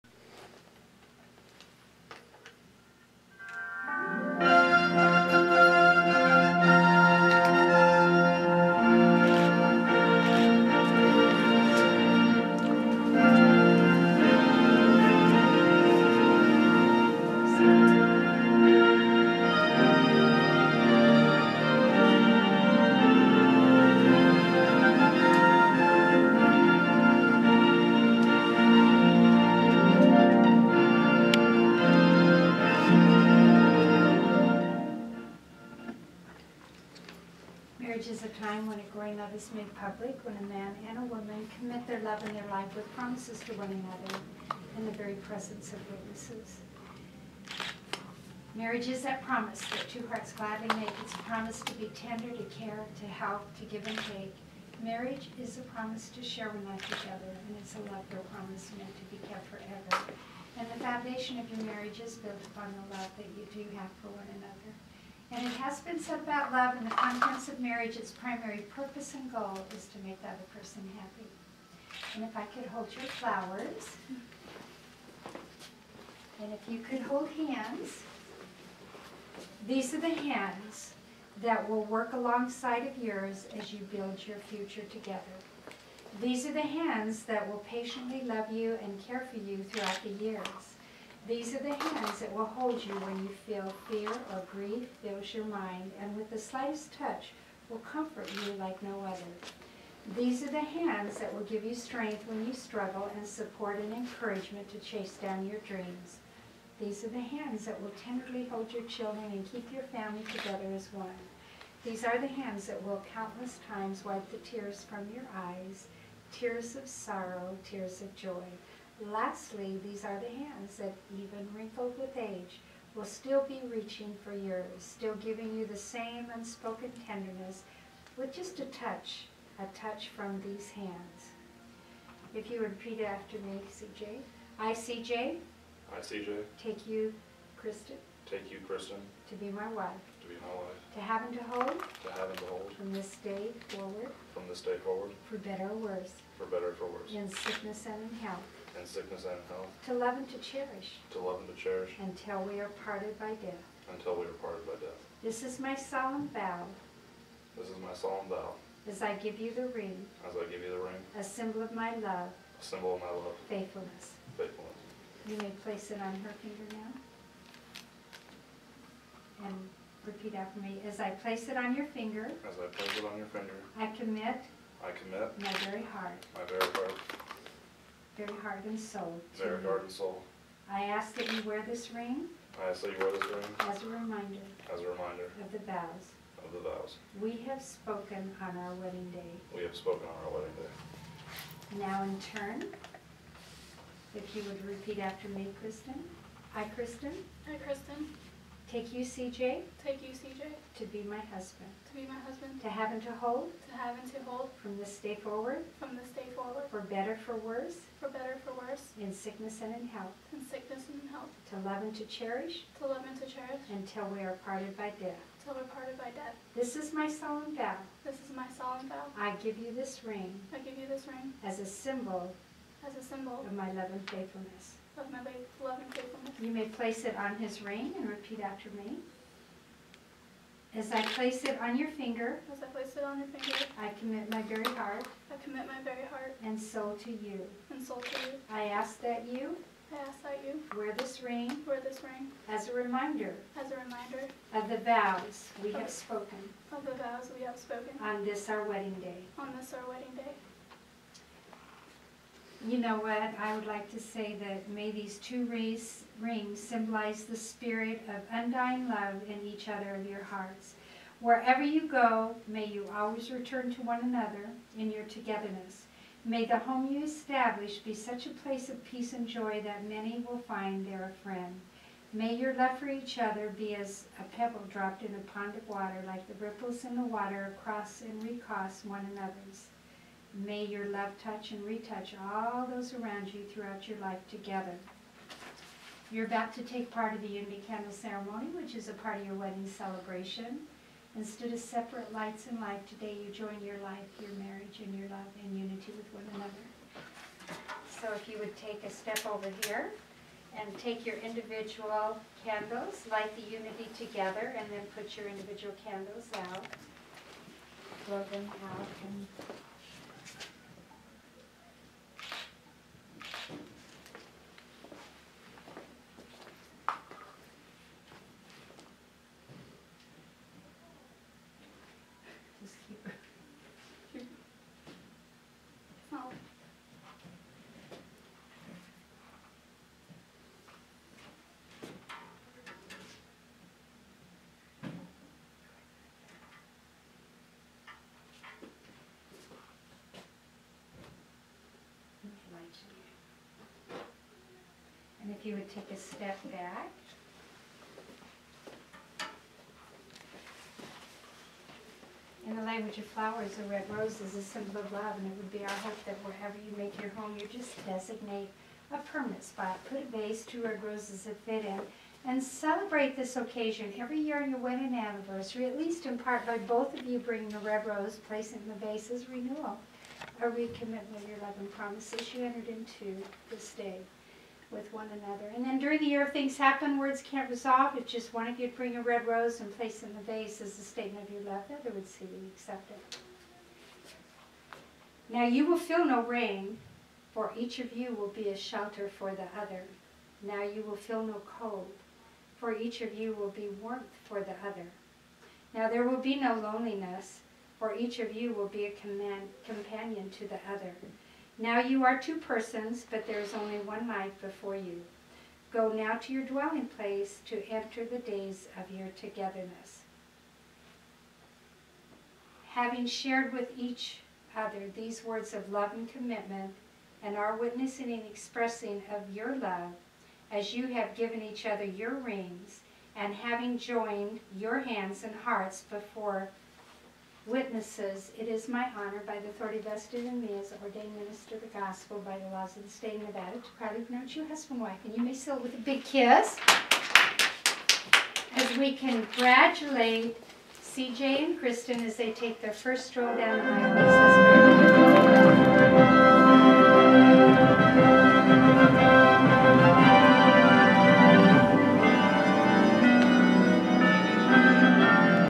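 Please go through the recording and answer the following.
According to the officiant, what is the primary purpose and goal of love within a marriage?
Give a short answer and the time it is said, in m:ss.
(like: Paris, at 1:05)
Make the other person happy, at 1:10.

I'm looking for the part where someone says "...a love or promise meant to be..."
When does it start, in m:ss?
0:57.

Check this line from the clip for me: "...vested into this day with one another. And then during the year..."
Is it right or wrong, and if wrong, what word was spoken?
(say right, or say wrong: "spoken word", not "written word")
wrong: "entered", not "vested".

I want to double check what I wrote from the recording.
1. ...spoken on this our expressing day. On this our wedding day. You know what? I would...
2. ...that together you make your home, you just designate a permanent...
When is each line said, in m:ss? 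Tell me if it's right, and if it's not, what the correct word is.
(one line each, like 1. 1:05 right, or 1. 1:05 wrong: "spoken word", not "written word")
1. 4:07 wrong: "wedding", not "expressing"
2. 5:56 wrong: "wherever", not "together".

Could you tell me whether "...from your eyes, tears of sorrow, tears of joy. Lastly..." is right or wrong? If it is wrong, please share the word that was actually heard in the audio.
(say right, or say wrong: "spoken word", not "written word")
right.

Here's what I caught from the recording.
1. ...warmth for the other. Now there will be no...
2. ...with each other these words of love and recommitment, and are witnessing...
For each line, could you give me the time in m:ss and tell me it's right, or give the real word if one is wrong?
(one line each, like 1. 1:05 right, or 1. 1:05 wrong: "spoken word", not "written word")
1. 6:33 right
2. 6:53 wrong: "commitment", not "recommitment".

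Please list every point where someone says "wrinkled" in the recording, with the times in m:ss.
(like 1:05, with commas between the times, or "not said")
2:01.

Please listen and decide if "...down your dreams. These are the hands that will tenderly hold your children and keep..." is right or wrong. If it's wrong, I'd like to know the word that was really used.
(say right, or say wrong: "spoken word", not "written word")
right.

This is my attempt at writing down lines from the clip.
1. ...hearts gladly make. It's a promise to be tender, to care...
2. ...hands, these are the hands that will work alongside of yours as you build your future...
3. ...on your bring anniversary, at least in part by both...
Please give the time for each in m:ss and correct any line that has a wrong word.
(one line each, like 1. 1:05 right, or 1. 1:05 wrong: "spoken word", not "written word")
1. 0:50 right
2. 1:17 right
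3. 6:04 wrong: "wedding", not "bring".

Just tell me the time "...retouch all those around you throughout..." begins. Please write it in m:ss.
4:41.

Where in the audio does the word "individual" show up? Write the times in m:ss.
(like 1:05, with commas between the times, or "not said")
5:01, 5:05.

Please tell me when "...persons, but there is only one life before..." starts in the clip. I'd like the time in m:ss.
6:42.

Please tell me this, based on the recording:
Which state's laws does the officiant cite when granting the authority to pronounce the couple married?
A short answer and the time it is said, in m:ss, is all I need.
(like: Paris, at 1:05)
Nevada, at 7:13.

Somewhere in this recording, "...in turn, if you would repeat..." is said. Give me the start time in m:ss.
3:12.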